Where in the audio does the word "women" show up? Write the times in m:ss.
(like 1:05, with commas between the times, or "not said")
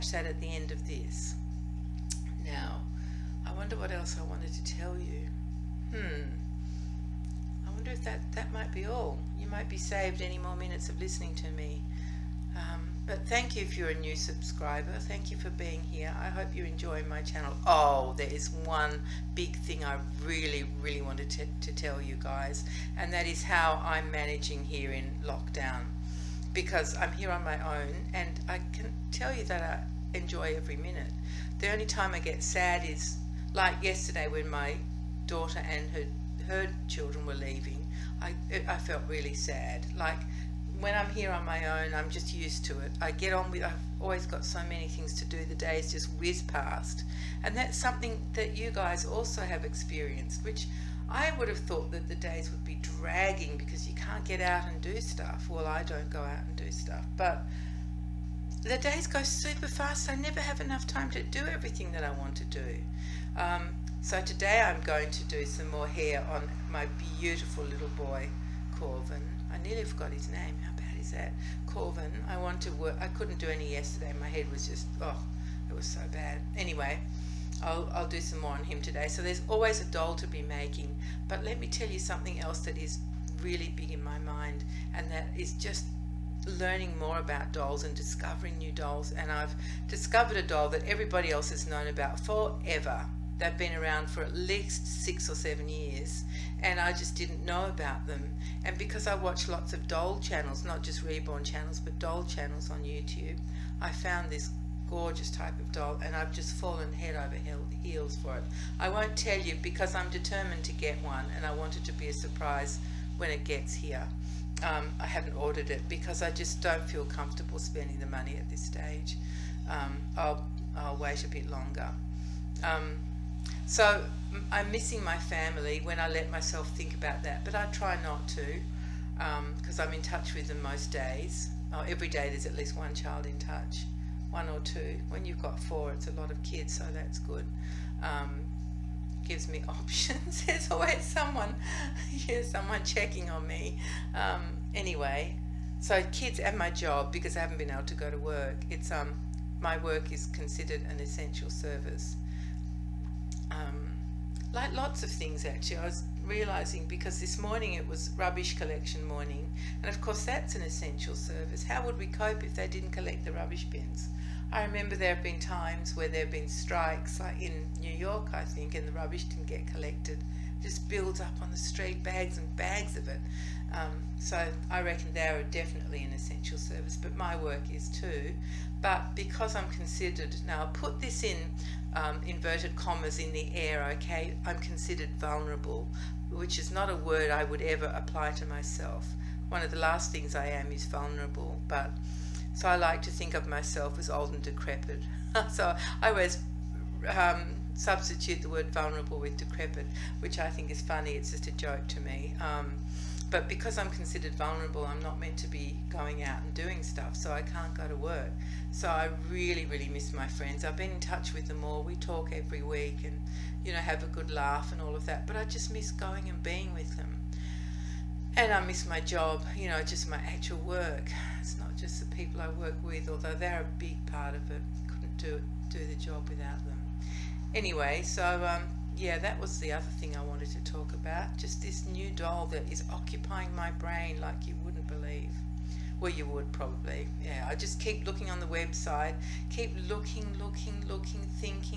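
not said.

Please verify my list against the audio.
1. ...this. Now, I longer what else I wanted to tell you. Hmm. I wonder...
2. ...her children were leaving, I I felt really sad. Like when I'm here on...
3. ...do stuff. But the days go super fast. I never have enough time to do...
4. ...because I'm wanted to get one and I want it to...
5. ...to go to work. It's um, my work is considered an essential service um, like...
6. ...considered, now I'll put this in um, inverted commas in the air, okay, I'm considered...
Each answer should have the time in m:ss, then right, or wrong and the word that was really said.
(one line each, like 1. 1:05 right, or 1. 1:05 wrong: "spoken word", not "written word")
1. 0:00 wrong: "wonder", not "longer"
2. 0:36 right
3. 0:56 right
4. 1:49 wrong: "determined", not "wanted"
5. 2:27 right
6. 2:59 right.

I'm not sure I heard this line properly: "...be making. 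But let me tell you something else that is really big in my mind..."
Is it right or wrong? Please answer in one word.
right.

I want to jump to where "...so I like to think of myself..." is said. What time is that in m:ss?
3:12.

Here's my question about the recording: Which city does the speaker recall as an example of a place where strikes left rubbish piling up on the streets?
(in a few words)
New York.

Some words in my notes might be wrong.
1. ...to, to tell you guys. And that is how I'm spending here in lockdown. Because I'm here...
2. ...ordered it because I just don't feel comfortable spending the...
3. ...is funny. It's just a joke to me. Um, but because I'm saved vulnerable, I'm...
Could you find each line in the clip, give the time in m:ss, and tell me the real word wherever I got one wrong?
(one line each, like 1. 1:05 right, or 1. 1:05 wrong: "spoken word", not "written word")
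1. 0:21 wrong: "managing", not "spending"
2. 1:55 right
3. 3:20 wrong: "considered", not "saved".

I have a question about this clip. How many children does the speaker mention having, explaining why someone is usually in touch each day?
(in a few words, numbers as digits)
4.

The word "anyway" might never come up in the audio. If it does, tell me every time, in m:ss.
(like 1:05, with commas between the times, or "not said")
1:16, 2:24, 3:47.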